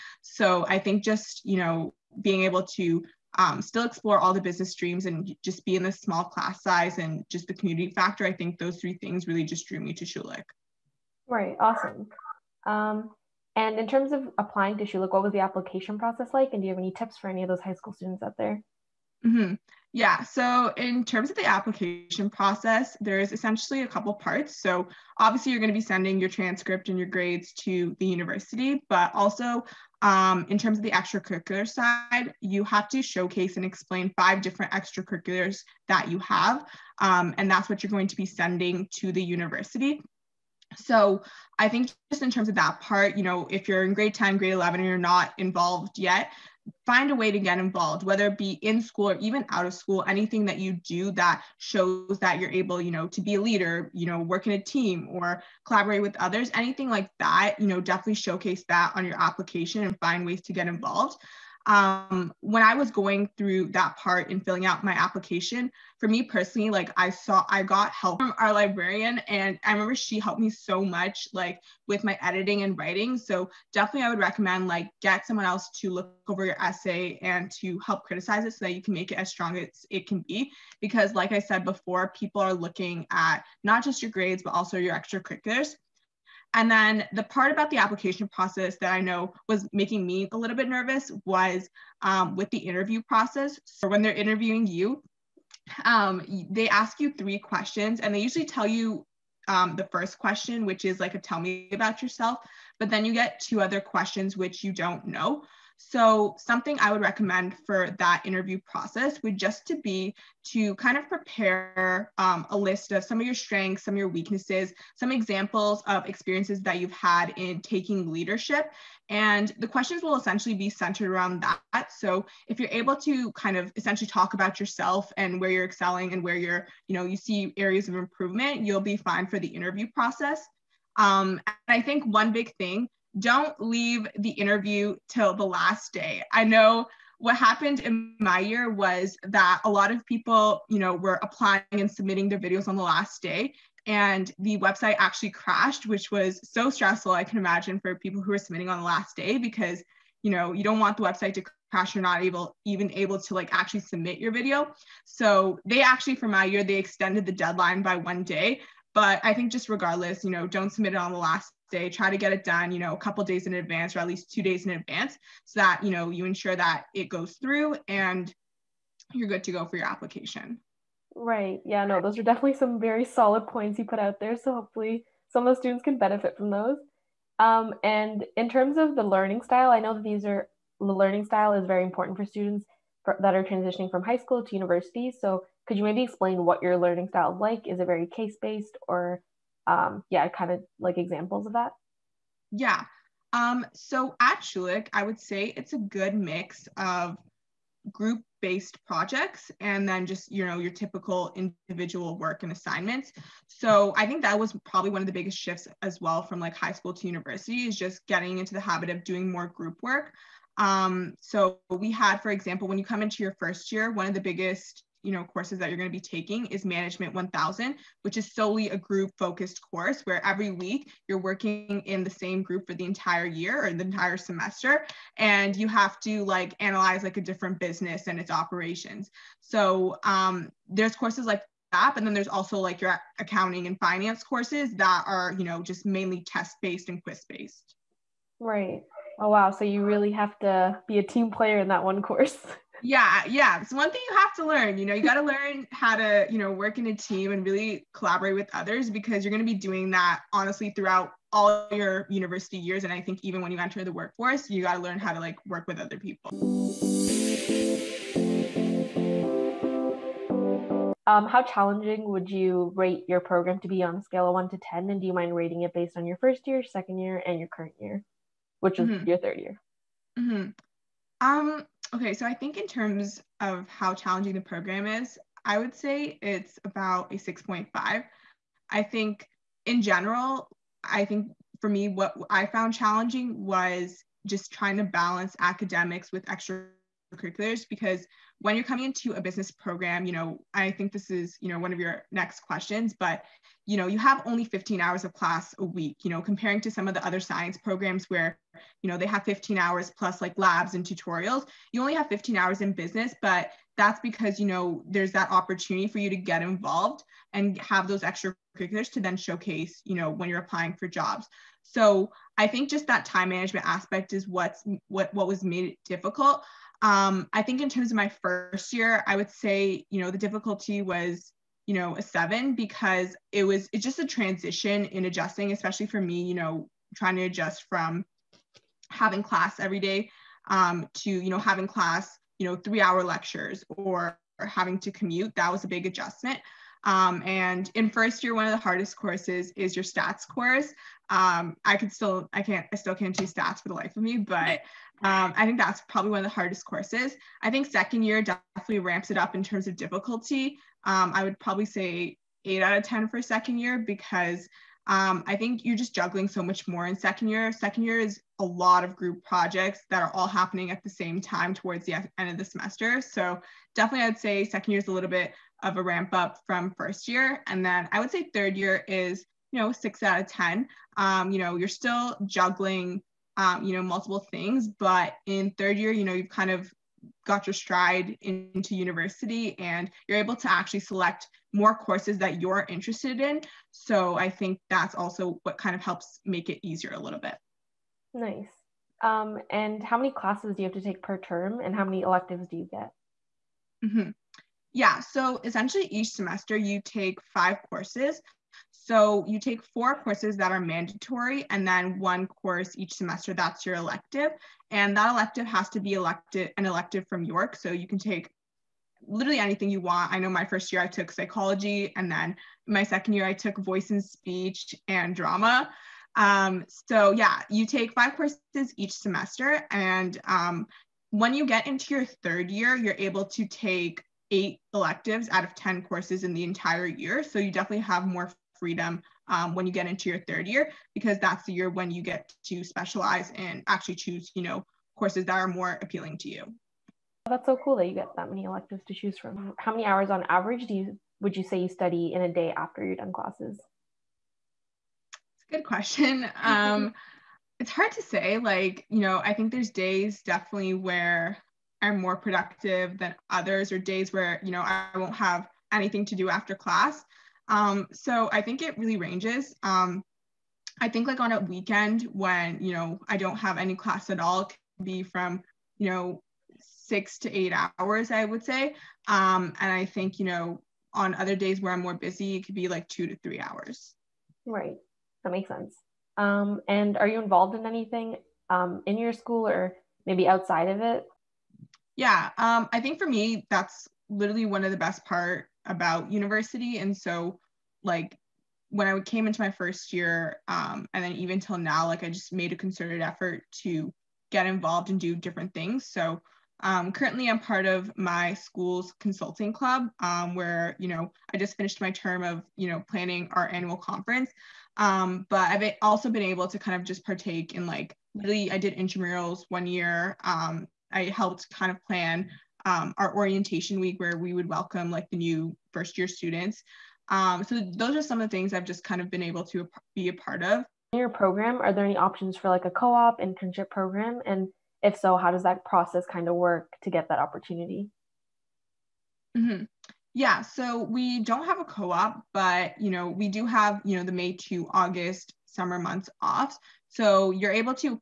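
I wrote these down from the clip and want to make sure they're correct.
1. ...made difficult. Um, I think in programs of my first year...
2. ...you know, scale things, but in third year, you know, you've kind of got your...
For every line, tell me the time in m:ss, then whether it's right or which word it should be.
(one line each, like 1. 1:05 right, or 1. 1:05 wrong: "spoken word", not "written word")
1. 5:15 wrong: "terms", not "programs"
2. 6:13 wrong: "multiple", not "scale".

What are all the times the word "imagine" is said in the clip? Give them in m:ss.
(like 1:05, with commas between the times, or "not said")
2:27.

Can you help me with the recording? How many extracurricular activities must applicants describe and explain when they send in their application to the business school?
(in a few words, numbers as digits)
5.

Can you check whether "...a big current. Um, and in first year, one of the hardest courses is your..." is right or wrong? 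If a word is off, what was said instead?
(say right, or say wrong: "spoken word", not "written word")
wrong: "adjustment", not "current".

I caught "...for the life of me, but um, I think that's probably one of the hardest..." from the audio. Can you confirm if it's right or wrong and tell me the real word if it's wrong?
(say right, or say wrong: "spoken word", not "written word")
right.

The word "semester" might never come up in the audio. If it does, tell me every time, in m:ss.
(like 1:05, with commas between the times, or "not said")
3:44, 6:02, 6:36, 6:42, 6:58.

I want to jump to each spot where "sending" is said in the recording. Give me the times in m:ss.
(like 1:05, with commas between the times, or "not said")
0:25, 0:38.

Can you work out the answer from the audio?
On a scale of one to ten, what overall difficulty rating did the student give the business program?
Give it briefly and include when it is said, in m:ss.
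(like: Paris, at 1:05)
6.5, at 4:37.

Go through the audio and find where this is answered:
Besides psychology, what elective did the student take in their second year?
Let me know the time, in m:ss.
6:53.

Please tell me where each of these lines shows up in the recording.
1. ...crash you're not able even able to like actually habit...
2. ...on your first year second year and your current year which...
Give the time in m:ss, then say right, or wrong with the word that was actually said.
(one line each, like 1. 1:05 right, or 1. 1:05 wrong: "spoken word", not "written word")
1. 2:31 wrong: "submit", not "habit"
2. 4:25 right.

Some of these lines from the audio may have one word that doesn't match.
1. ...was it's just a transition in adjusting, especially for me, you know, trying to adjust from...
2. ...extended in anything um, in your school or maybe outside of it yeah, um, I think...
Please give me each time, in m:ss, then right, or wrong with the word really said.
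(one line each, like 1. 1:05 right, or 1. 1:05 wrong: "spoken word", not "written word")
1. 5:23 right
2. 7:57 wrong: "involved", not "extended".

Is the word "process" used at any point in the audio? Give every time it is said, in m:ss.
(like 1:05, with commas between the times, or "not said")
0:15, 0:22, 1:28, 1:33, 1:48, 2:09, 8:45.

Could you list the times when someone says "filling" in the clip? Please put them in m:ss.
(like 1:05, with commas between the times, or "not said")
1:04.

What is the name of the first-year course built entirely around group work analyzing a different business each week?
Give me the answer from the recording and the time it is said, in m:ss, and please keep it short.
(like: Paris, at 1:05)
Management 1000, at 3:36.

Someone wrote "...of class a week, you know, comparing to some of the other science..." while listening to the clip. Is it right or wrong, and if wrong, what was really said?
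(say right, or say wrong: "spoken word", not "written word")
right.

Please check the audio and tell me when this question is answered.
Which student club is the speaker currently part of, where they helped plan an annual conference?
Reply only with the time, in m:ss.
8:19.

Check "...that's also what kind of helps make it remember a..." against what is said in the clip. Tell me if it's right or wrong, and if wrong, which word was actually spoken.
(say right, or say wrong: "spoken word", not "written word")
wrong: "easier", not "remember".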